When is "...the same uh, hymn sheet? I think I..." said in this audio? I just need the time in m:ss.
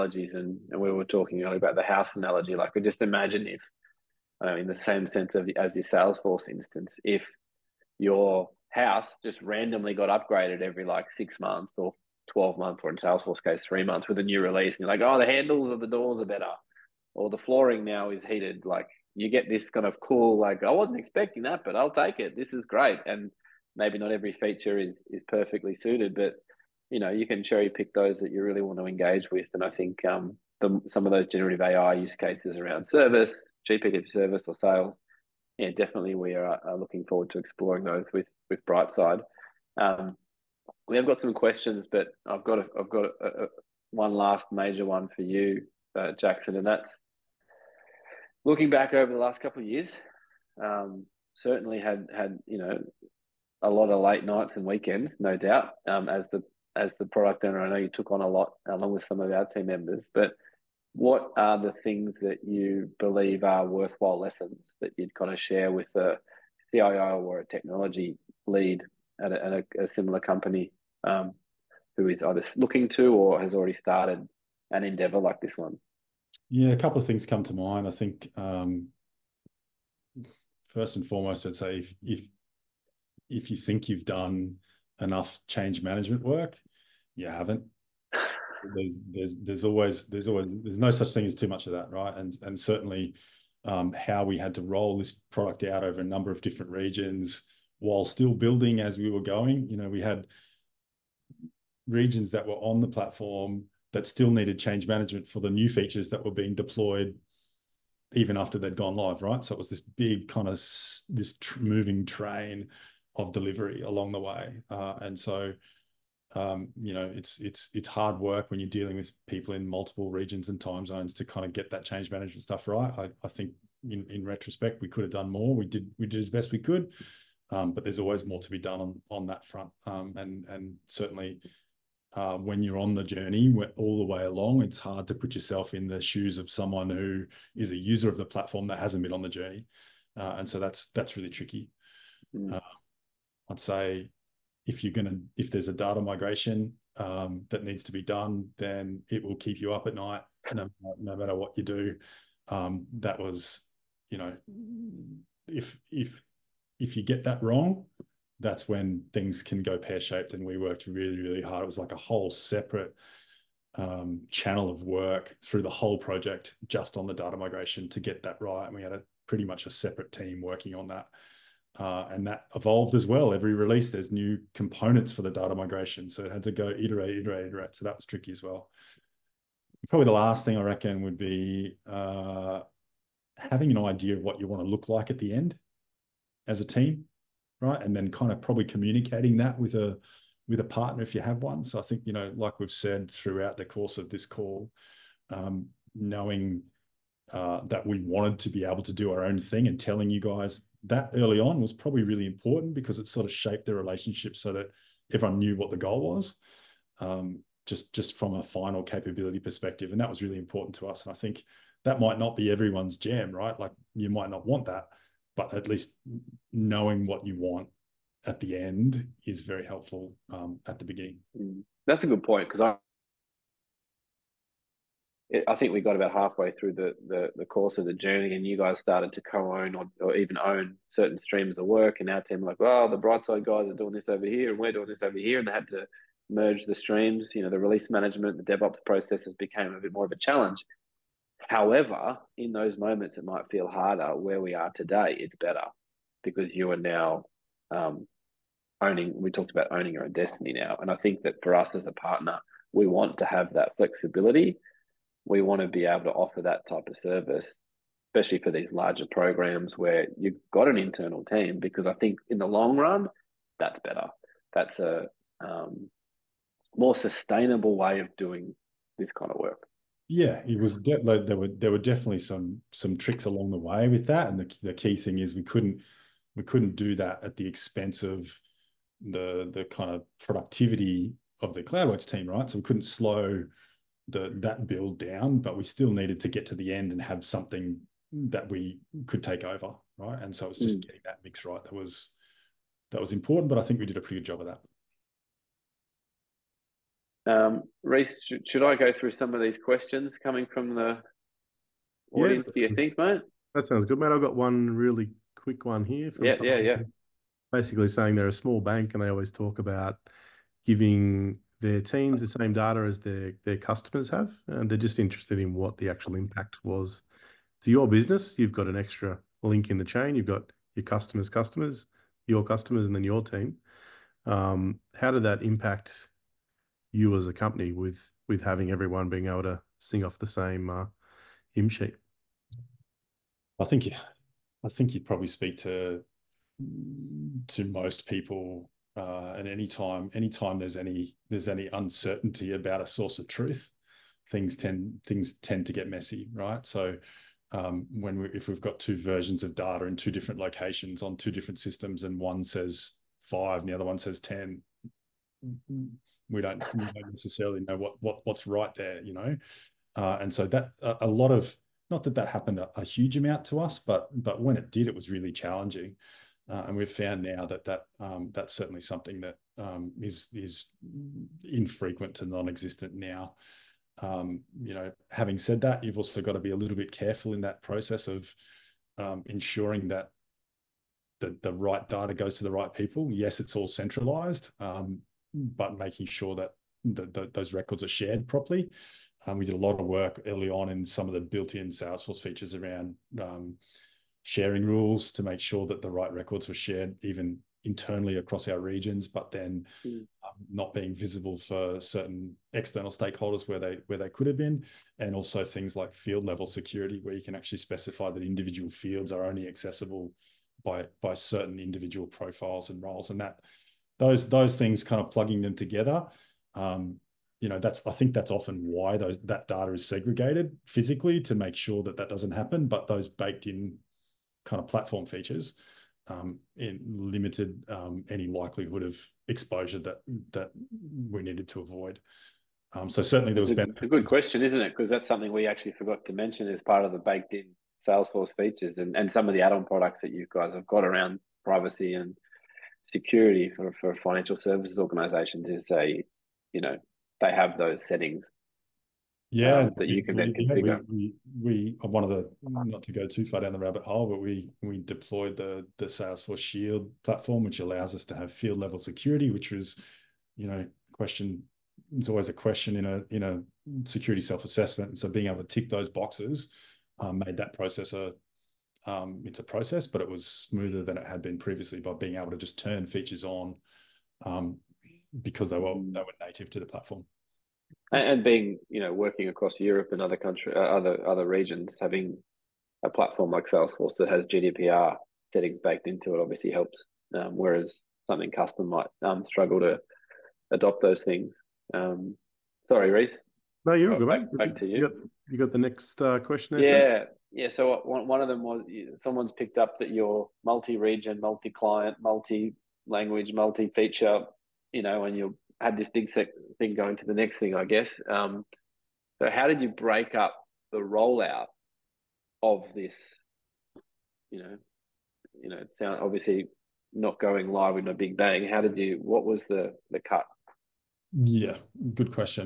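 5:30.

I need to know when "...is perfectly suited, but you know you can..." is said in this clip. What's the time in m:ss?
0:25.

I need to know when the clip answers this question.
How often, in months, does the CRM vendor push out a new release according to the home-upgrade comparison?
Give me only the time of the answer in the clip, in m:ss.
0:13.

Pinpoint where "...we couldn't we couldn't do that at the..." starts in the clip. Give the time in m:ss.
4:35.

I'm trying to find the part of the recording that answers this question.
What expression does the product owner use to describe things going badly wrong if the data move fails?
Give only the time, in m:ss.
2:39.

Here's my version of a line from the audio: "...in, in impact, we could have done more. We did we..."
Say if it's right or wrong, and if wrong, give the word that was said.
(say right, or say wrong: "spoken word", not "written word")
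wrong: "retrospect", not "impact".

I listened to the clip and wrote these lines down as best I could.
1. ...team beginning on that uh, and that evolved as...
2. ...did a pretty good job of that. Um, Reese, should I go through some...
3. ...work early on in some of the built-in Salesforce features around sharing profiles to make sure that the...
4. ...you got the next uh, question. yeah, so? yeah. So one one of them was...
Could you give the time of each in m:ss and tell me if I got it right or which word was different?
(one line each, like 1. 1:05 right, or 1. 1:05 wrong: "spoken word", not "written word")
1. 2:50 wrong: "working", not "beginning"
2. 4:53 right
3. 6:29 wrong: "rules", not "profiles"
4. 8:15 right.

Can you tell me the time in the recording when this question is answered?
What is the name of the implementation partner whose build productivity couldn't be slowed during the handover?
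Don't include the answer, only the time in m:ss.
4:41.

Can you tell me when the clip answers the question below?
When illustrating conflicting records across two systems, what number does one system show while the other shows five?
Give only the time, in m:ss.
5:54.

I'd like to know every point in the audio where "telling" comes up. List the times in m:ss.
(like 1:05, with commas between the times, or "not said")
3:19.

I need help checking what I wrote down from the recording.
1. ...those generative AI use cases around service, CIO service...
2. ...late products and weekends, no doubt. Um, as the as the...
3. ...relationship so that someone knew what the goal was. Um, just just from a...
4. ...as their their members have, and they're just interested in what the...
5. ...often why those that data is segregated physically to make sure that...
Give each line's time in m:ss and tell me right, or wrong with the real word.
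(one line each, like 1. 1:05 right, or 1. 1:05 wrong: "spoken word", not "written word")
1. 0:31 wrong: "GPT", not "CIO"
2. 0:54 wrong: "nights", not "products"
3. 3:23 wrong: "everyone", not "someone"
4. 5:12 wrong: "customers", not "members"
5. 6:58 right.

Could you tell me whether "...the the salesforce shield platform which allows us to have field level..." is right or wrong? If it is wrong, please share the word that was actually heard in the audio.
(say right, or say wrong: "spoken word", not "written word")
right.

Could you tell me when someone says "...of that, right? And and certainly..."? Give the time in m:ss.
1:31.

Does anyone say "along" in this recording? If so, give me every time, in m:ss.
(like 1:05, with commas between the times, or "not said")
0:58, 1:53, 2:14, 4:33.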